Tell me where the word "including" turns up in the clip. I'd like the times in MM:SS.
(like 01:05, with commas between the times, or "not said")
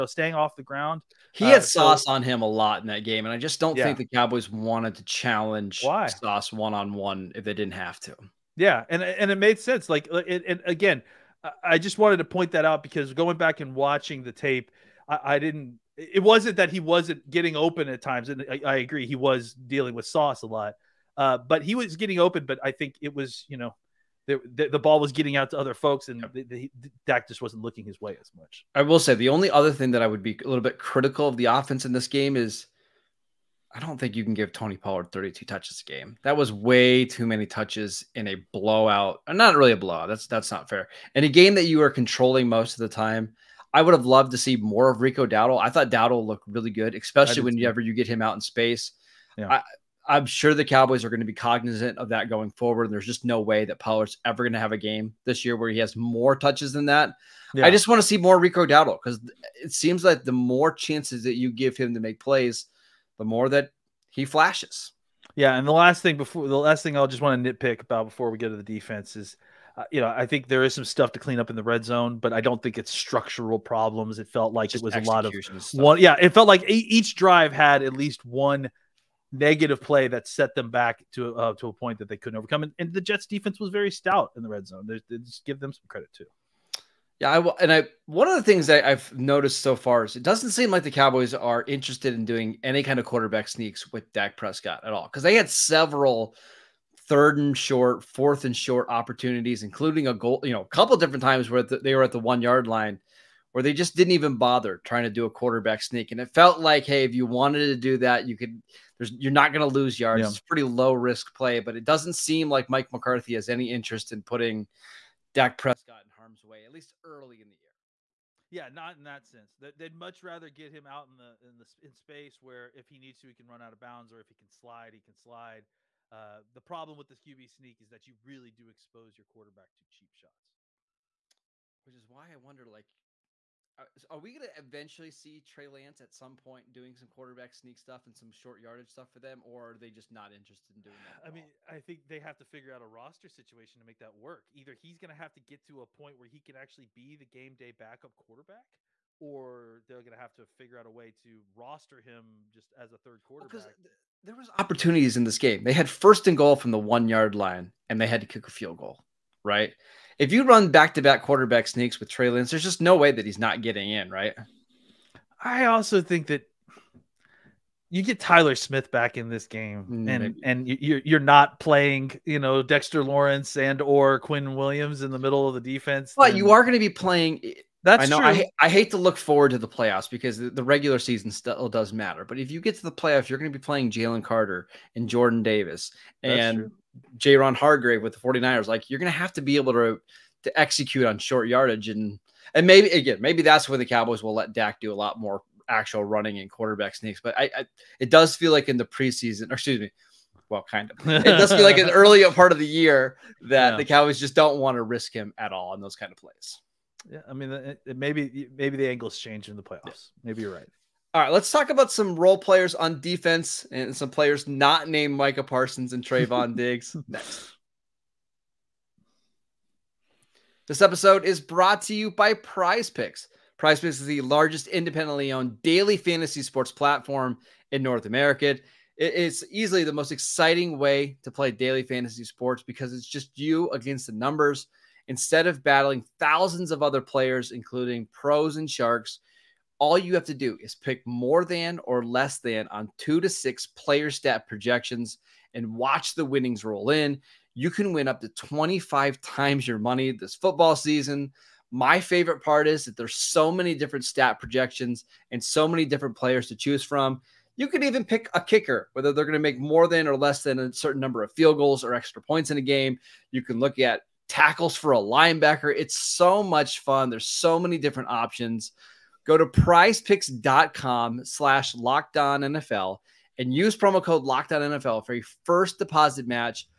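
01:39, 03:57.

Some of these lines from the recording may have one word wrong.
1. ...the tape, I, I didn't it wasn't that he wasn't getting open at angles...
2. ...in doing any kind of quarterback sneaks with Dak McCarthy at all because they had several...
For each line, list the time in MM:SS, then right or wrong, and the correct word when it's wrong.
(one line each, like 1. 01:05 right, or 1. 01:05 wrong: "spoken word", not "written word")
1. 00:14 wrong: "times", not "angles"
2. 01:32 wrong: "Prescott", not "McCarthy".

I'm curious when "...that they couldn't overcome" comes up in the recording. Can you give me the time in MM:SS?
01:21.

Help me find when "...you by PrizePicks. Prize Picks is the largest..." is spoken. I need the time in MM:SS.
03:41.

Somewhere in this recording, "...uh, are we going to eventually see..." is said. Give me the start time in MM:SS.
02:13.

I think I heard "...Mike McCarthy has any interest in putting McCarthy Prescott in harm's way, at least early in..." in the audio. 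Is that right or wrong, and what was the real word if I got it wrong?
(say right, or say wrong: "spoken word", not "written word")
wrong: "Dak", not "McCarthy".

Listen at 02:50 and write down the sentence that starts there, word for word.
and and you're you're not playing you know Dexter Lawrence and or Quinn Williams in the middle of the defense.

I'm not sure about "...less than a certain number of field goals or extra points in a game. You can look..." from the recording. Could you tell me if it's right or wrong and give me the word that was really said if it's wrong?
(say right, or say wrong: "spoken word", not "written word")
right.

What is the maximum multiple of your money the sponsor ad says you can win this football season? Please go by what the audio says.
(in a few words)
25 times.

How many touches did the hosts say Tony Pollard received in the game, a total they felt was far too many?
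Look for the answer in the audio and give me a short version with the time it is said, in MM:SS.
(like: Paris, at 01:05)
32, at 00:35.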